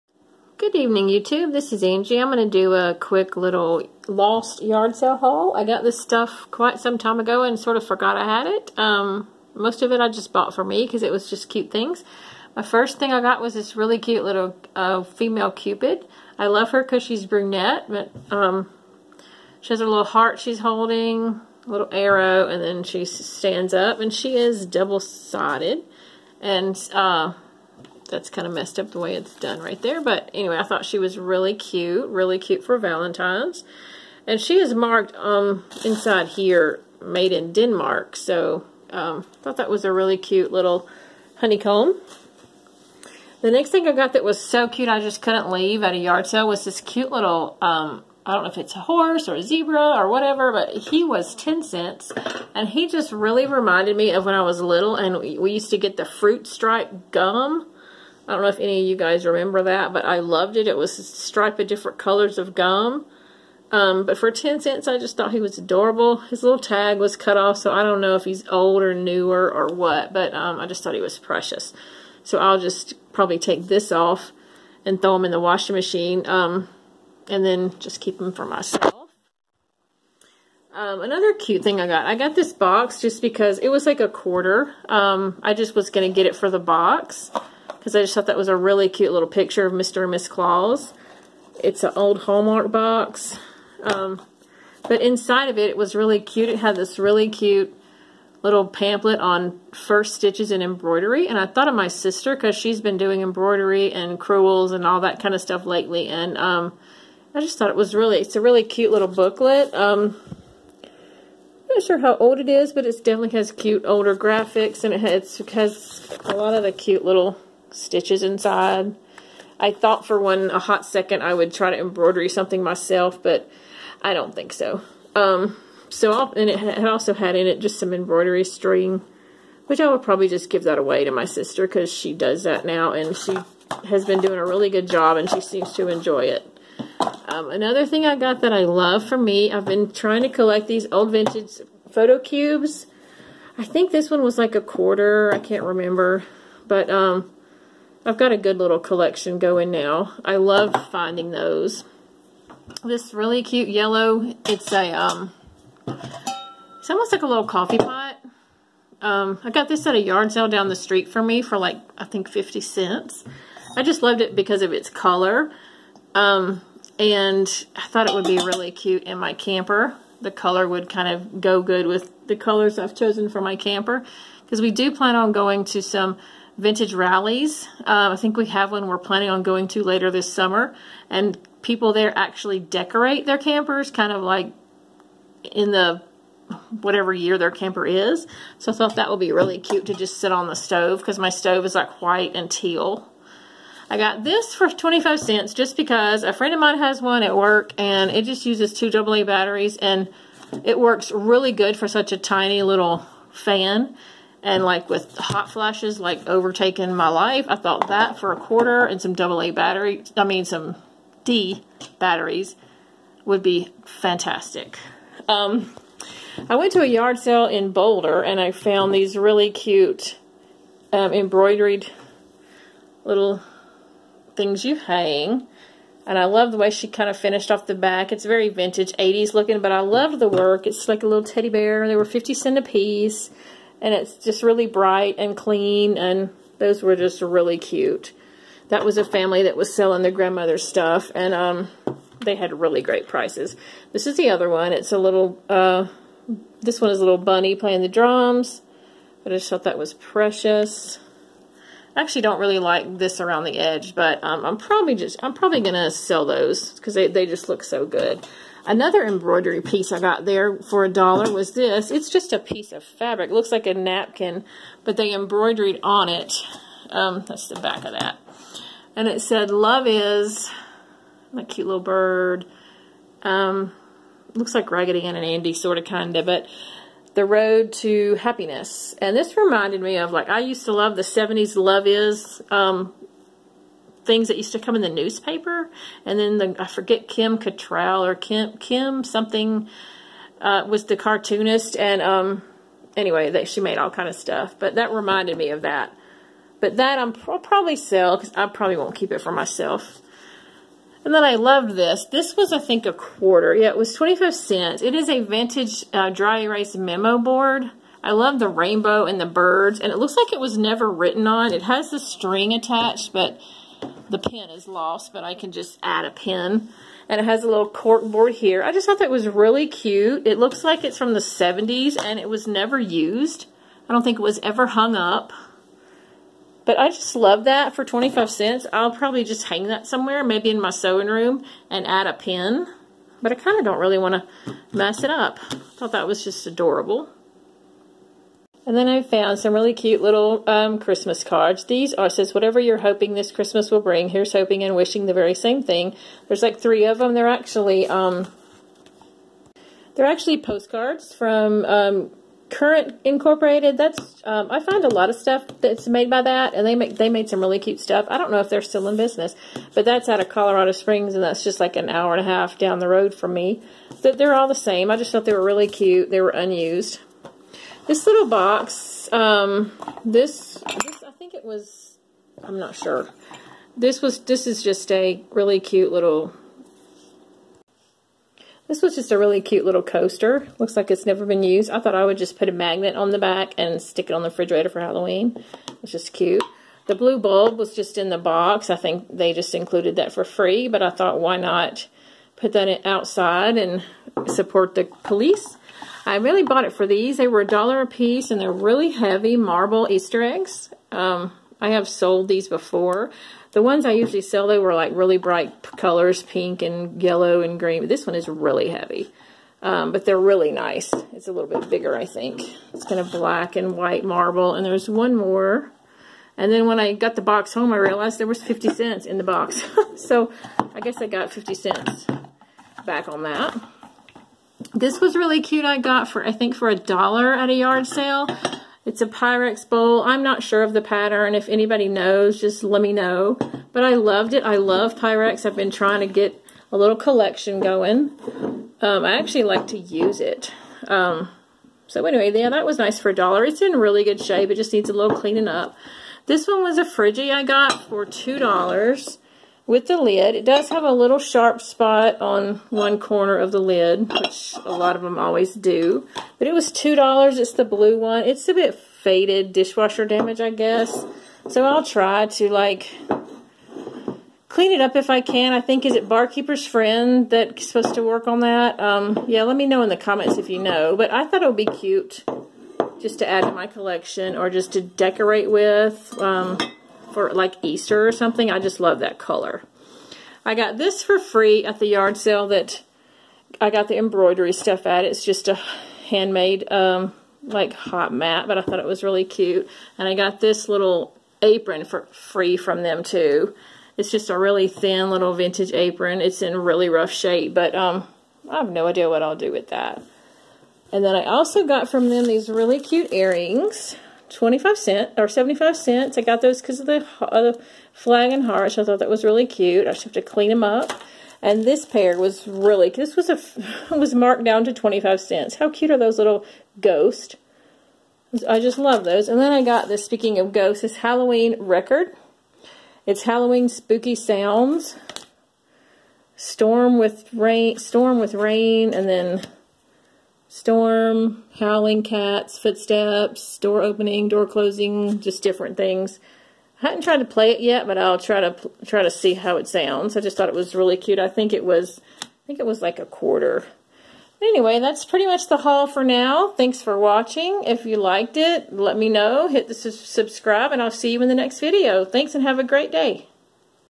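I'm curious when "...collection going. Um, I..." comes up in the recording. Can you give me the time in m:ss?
7:16.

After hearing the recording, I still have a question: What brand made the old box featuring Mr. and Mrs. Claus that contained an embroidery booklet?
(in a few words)
Hallmark.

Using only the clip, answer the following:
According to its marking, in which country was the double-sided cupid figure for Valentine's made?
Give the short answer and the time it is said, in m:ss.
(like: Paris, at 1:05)
Denmark, at 0:37.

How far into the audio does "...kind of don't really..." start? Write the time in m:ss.
5:33.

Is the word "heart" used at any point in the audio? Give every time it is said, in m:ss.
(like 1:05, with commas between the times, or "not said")
0:20, 8:28.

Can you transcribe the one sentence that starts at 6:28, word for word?
I think they just included that for free, but I thought why not put that outside and support the police.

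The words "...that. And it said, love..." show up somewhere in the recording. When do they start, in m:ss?
4:27.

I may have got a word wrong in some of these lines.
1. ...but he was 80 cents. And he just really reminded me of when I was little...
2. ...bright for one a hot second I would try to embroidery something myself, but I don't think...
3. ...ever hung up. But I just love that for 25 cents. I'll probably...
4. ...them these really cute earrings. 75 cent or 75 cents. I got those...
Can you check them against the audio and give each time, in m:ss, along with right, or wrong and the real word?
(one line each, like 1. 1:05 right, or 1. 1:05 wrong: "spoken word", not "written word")
1. 0:50 wrong: "10", not "80"
2. 1:59 wrong: "thought", not "bright"
3. 5:24 right
4. 8:22 wrong: "25", not "75".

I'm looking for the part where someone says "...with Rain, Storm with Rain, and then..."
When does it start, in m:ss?
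8:46.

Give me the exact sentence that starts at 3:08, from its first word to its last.
So I thought that would be really cute to just sit on the stove because my stove is like white and teal.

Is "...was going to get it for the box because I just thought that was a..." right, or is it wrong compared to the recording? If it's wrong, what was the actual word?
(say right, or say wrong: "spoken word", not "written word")
right.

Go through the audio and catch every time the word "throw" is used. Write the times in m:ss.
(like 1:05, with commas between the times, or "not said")
1:15.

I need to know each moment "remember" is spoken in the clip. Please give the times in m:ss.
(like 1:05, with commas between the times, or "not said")
0:59, 2:25.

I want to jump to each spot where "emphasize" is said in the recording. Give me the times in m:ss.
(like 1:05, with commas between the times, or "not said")
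not said.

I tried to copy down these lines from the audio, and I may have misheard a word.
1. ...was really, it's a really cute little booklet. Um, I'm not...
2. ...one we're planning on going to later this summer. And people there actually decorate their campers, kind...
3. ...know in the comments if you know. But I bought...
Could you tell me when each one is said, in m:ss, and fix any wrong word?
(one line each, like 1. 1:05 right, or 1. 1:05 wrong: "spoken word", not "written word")
1. 1:47 right
2. 2:58 right
3. 7:49 wrong: "thought", not "bought".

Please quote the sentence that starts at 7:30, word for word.
It does have a little sharp spot on one corner of the lid, which a lot of them always do.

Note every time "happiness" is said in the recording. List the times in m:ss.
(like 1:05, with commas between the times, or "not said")
4:38.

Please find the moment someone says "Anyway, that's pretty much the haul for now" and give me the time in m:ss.
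9:04.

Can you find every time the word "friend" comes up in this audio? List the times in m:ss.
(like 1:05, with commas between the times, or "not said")
3:16, 7:46.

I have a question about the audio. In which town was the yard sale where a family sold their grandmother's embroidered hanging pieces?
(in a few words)
Boulder.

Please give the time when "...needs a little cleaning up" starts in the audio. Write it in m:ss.
7:24.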